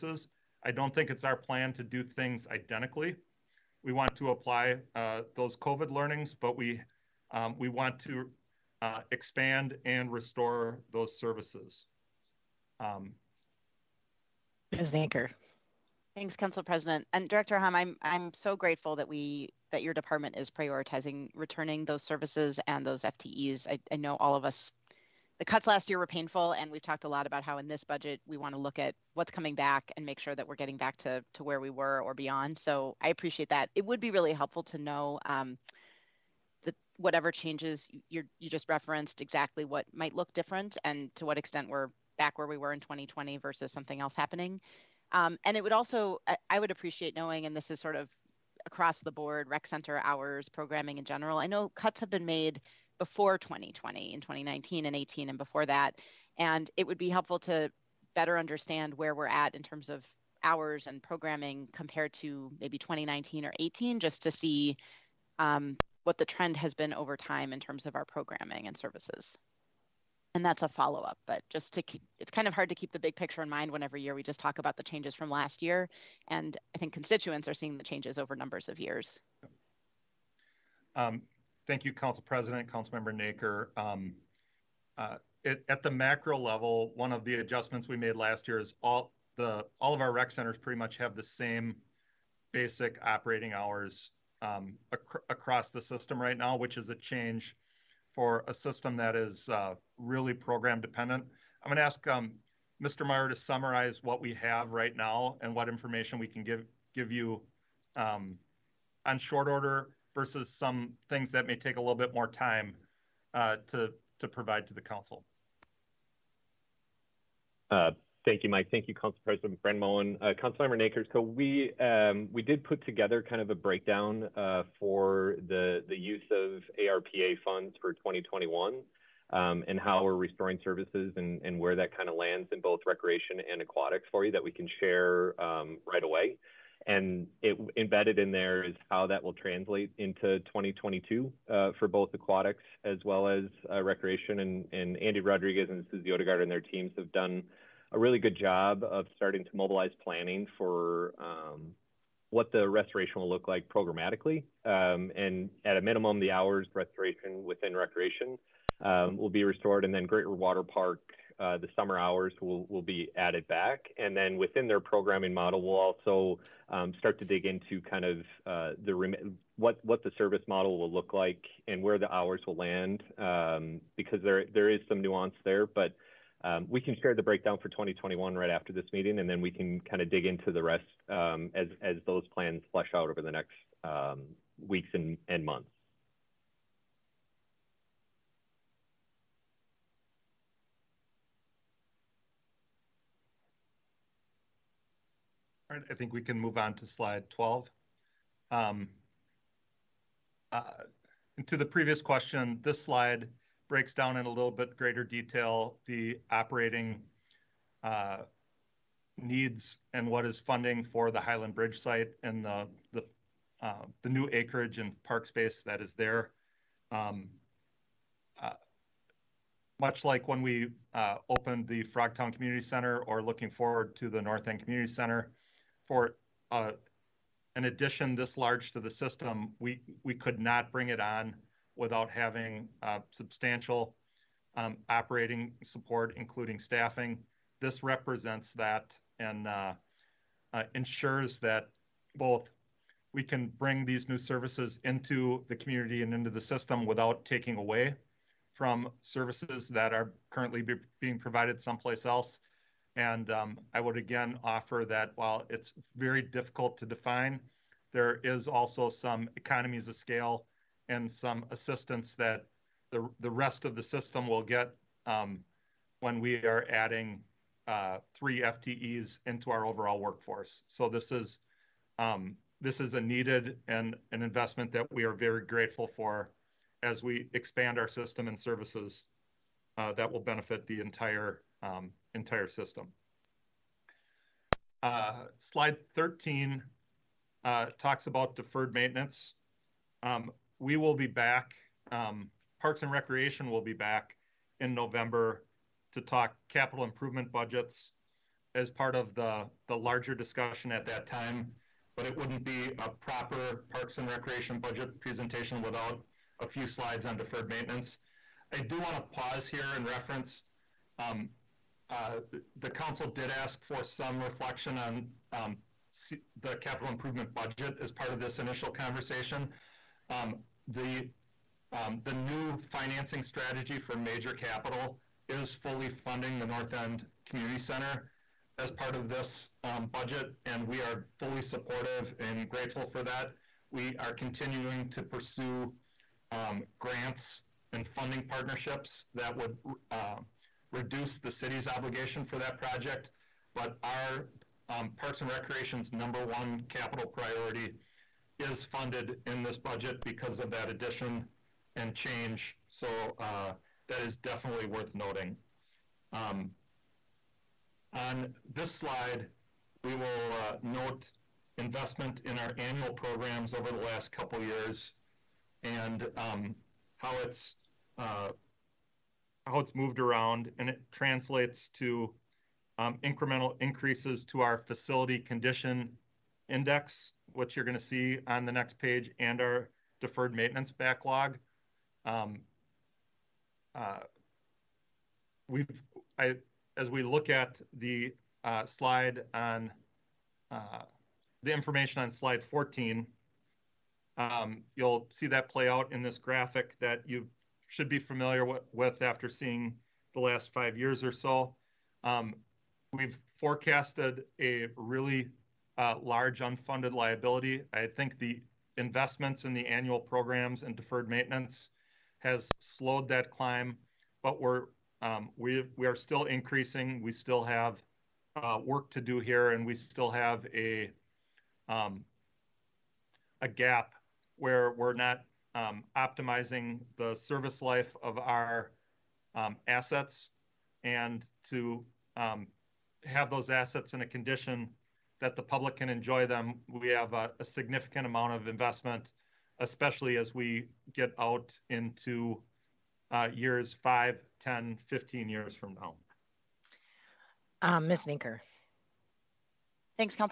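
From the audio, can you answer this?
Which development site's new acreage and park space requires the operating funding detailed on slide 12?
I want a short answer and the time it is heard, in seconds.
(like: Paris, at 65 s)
Highland Bridge, at 211 s.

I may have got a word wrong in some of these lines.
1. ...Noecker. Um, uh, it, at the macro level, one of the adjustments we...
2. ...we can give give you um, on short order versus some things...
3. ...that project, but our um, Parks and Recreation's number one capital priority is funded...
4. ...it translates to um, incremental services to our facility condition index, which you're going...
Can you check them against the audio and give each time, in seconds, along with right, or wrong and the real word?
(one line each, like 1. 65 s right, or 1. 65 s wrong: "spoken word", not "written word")
1. 83 s right
2. 106 s right
3. 342 s right
4. 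370 s wrong: "increases", not "services".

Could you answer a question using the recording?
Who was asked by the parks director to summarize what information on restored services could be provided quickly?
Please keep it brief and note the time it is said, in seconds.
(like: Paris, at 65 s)
Mr. Meyer, at 102 s.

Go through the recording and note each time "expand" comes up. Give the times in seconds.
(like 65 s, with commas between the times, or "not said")
9 s, 277 s.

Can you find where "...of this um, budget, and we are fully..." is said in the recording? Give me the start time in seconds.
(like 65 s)
328 s.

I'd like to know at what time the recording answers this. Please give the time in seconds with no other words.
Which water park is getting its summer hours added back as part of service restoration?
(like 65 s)
160 s.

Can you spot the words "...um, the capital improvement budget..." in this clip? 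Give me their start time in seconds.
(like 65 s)
315 s.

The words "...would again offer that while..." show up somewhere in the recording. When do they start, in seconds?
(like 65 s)
253 s.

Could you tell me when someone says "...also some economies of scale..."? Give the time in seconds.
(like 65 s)
258 s.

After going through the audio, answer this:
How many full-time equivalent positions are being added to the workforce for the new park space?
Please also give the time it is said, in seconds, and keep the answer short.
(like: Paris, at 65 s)
3, at 268 s.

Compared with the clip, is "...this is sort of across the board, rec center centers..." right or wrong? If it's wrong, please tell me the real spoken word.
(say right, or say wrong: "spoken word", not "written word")
wrong: "hours", not "centers".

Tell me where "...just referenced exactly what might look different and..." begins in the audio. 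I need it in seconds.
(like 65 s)
38 s.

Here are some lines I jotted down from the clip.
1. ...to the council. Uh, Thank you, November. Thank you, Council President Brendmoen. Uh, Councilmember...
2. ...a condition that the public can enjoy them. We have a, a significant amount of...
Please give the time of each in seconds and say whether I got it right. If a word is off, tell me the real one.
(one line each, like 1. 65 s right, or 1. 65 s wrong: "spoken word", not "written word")
1. 114 s wrong: "Mike", not "November"
2. 434 s right.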